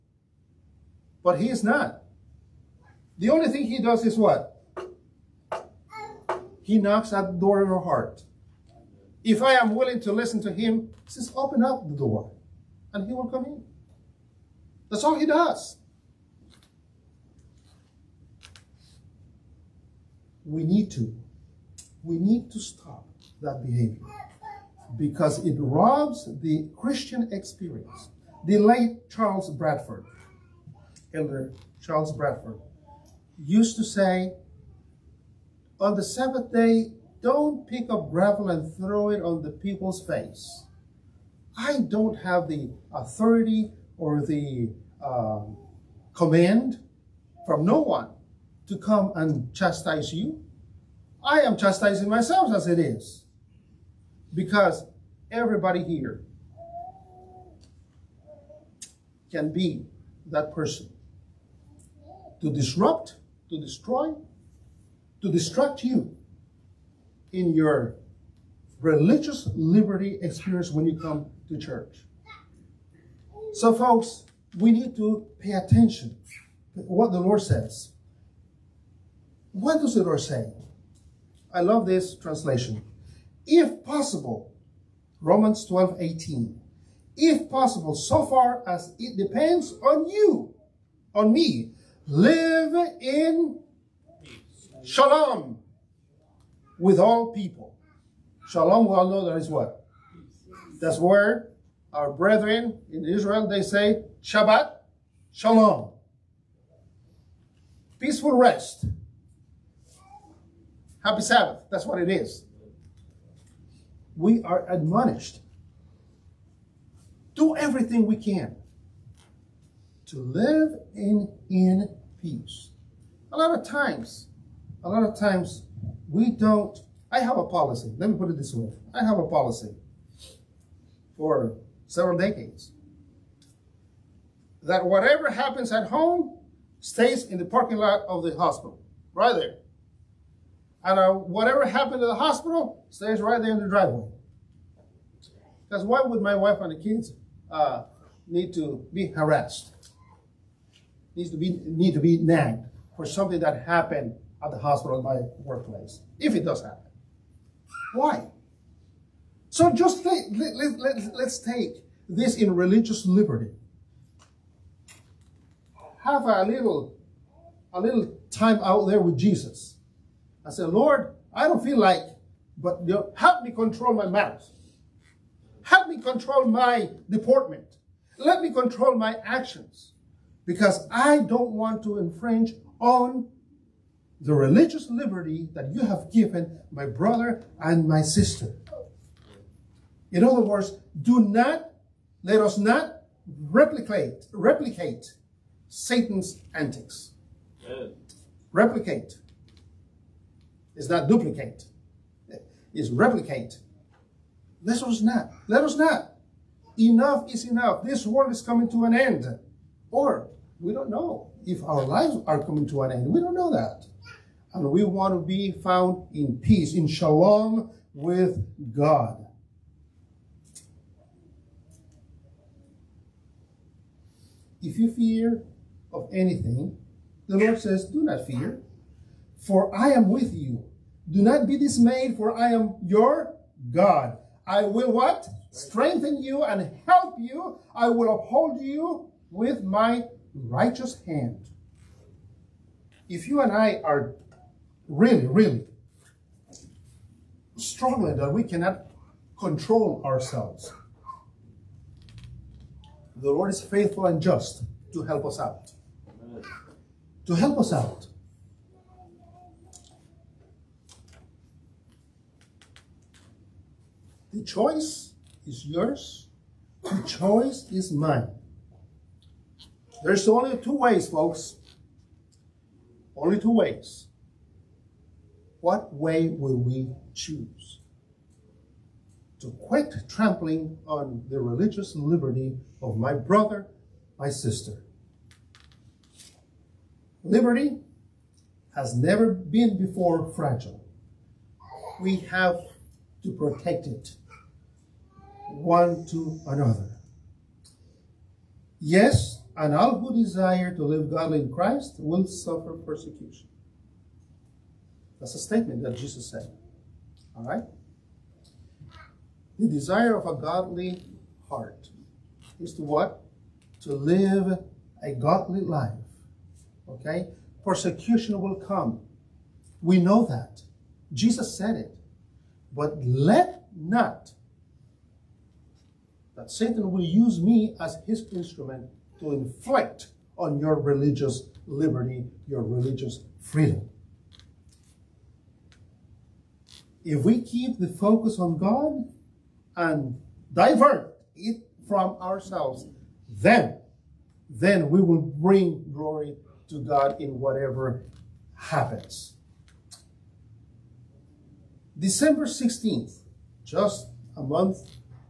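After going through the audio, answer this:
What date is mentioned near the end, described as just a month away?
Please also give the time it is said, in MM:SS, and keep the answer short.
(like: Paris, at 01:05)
December 16, at 05:51.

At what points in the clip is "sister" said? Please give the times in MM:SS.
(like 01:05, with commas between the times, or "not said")
03:08, 04:44.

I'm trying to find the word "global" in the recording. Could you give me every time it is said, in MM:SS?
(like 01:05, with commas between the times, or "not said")
not said.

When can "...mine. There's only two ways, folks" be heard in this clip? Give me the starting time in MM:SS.
04:27.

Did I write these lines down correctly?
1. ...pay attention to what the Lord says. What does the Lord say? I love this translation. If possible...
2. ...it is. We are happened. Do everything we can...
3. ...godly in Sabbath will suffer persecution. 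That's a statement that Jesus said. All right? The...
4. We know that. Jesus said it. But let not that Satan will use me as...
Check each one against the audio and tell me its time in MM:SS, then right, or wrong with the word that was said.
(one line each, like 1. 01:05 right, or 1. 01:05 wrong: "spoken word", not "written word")
1. 01:15 right
2. 01:52 wrong: "admonished", not "happened"
3. 05:01 wrong: "Christ", not "Sabbath"
4. 05:19 right.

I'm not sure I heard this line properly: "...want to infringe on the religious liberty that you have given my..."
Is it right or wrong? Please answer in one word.
right.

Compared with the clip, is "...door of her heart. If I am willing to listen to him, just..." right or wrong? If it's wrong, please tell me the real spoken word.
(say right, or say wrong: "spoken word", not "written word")
right.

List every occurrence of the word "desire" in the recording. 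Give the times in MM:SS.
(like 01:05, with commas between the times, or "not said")
05:00, 05:09.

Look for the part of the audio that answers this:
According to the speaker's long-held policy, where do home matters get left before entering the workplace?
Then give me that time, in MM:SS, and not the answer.
02:17.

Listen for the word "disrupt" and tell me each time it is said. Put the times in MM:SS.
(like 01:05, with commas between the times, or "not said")
01:02.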